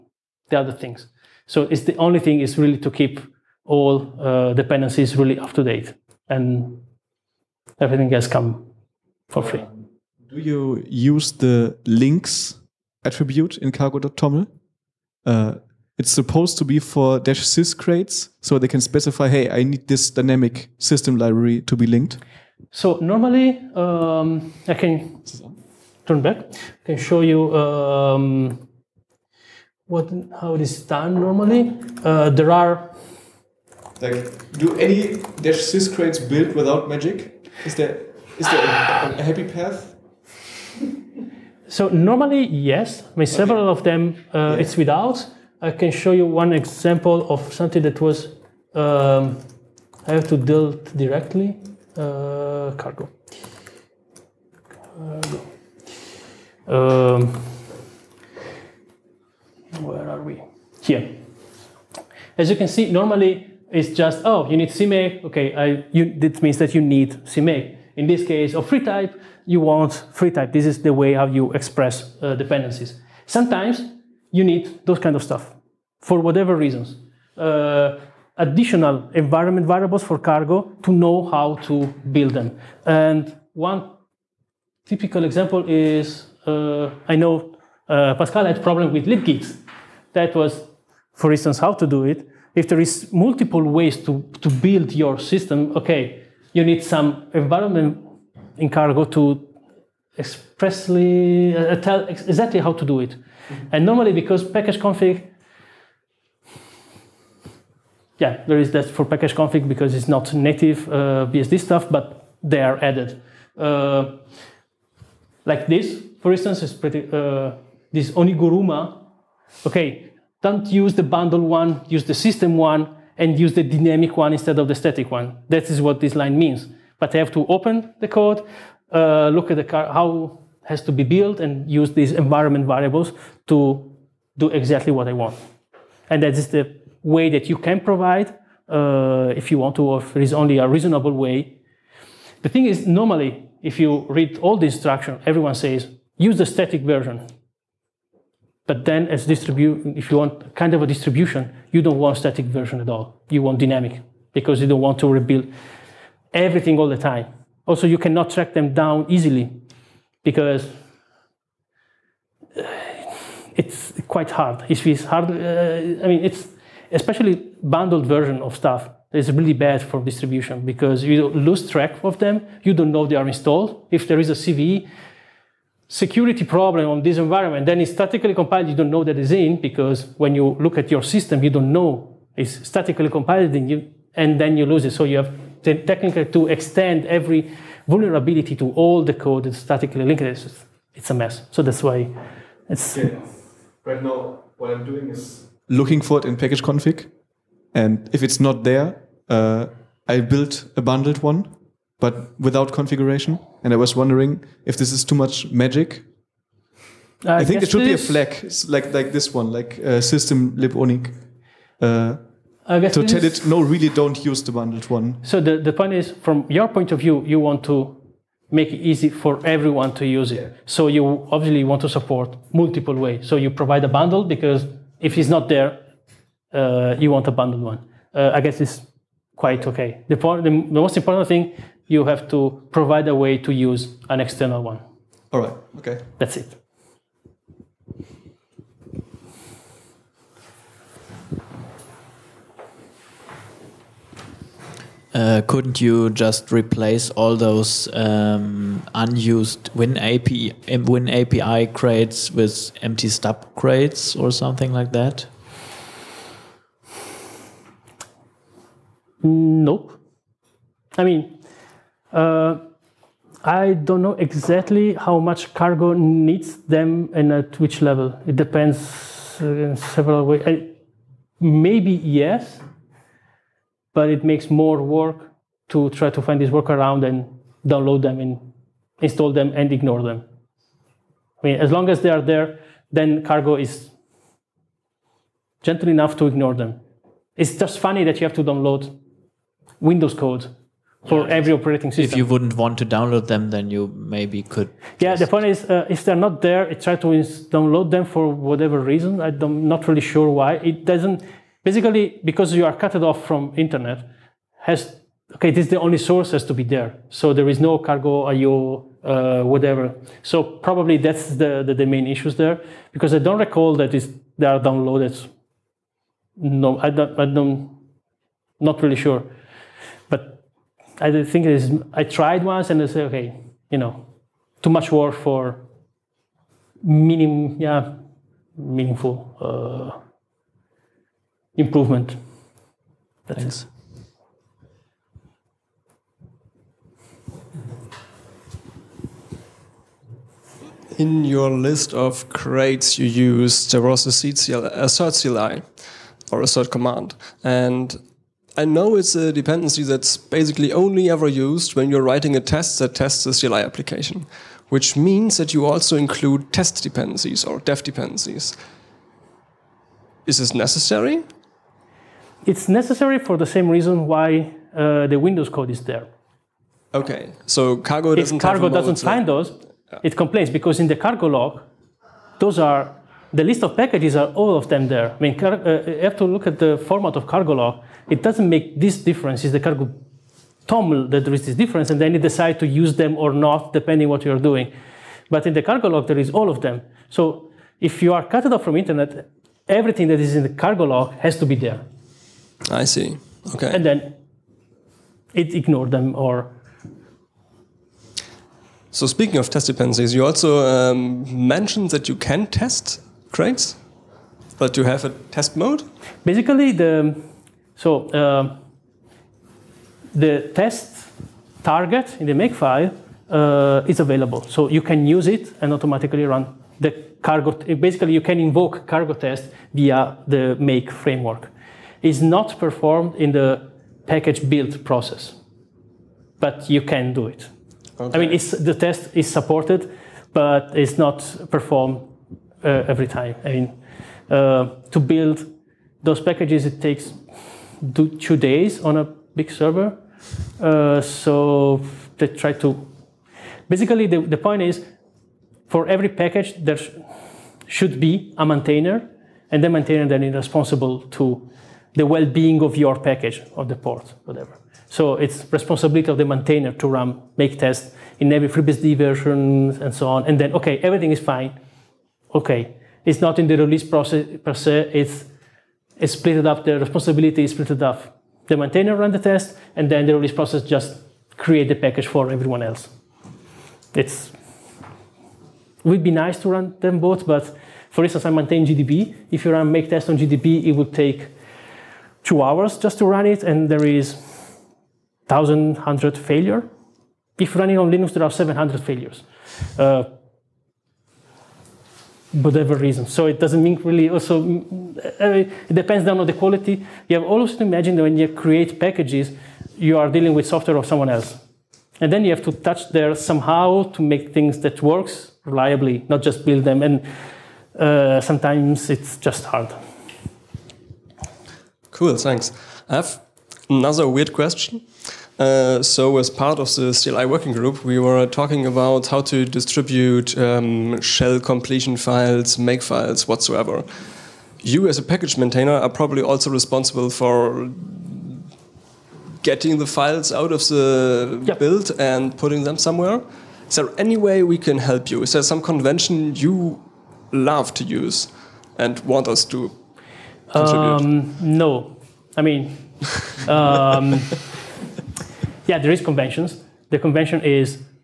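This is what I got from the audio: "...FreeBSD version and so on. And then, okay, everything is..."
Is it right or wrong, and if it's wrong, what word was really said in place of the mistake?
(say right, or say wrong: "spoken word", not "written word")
right.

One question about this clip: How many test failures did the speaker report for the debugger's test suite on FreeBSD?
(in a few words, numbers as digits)
1,100.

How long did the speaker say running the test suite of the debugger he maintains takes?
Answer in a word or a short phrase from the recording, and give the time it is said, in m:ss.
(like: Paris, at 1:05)
2 hours, at 8:02.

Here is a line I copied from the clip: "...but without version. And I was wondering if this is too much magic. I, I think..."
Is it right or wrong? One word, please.
wrong.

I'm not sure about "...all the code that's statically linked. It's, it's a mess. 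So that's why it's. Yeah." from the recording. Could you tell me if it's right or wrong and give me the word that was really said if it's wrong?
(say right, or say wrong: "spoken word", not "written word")
right.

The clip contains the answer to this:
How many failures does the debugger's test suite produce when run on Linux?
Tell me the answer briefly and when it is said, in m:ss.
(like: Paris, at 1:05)
700, at 8:08.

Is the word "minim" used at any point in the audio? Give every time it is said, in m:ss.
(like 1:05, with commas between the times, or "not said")
5:26.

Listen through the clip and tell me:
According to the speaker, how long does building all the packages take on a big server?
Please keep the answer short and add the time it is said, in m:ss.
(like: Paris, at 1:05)
2 days, at 7:18.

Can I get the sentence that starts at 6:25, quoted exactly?
But in the cargo log, there is all of them.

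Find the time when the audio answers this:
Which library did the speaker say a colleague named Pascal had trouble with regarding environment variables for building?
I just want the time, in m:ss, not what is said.
1:29.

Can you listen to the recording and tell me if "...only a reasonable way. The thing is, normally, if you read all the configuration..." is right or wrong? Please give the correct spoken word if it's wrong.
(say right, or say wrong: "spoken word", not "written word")
wrong: "instruction", not "configuration".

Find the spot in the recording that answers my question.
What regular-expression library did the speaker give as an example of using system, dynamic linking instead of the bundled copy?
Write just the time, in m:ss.
1:58.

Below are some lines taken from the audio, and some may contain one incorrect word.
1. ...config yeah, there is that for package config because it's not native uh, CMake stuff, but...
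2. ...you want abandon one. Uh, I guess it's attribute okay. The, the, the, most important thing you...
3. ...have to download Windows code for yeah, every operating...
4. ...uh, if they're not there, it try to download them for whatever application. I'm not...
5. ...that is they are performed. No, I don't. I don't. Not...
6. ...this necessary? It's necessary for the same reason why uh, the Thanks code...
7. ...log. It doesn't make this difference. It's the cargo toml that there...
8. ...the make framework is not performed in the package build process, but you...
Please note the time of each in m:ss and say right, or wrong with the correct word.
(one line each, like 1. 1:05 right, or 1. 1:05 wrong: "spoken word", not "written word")
1. 1:44 wrong: "BSD", not "CMake"
2. 3:46 wrong: "quite", not "attribute"
3. 4:48 right
4. 4:55 wrong: "reason", not "application"
5. 5:13 wrong: "downloaded", not "performed"
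6. 6:00 wrong: "Windows", not "Thanks"
7. 6:17 right
8. 7:00 right.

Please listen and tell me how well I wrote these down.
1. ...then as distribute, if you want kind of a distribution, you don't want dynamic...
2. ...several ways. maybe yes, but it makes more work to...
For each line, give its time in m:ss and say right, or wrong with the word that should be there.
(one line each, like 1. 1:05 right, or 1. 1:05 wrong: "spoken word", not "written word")
1. 2:28 wrong: "static", not "dynamic"
2. 4:29 right.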